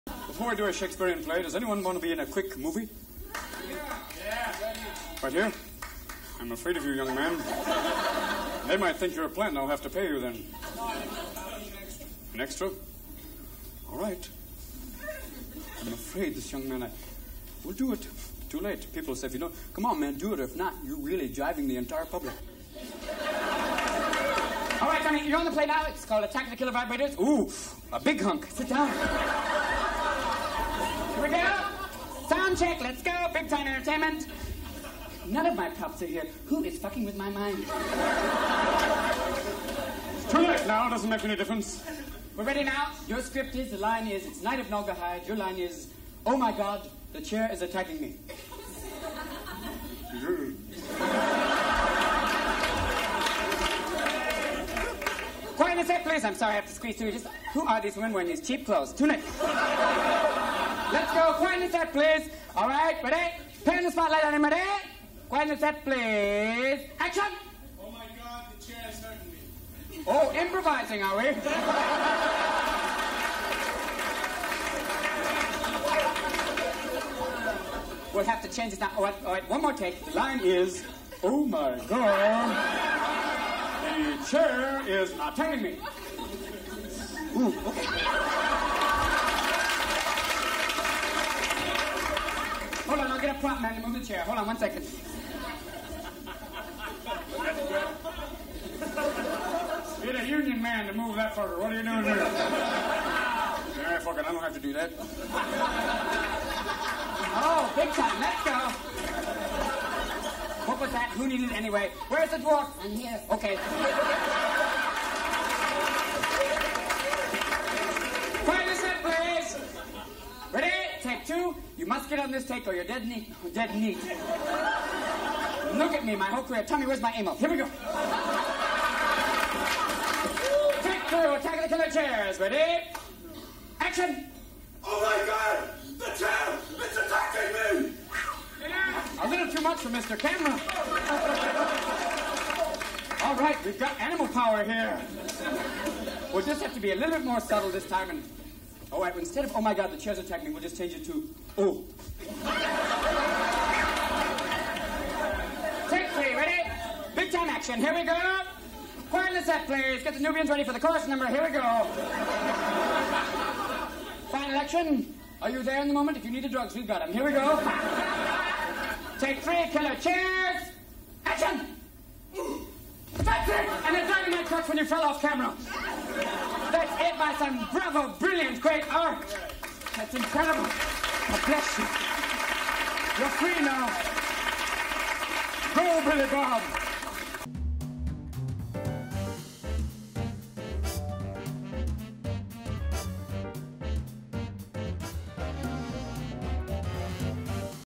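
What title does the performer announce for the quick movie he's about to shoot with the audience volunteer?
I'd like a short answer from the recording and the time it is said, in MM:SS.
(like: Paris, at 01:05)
Attack of the Killer Vibrators, at 00:26.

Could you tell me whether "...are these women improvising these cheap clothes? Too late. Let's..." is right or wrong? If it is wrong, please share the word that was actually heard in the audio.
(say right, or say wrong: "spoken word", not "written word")
wrong: "wearing", not "improvising".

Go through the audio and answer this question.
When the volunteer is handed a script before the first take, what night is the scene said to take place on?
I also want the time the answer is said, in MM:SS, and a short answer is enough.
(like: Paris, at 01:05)
Night of Naugahyde, at 00:44.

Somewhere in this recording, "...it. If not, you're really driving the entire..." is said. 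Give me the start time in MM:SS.
00:20.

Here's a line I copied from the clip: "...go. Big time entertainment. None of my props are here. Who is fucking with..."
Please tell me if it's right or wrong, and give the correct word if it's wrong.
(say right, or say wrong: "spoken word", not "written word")
right.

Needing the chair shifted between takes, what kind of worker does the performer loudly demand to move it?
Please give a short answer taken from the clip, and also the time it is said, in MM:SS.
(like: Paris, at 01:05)
A union man, at 01:40.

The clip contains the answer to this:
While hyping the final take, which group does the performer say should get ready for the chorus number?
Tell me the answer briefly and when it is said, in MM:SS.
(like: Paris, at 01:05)
The Nubians, at 02:40.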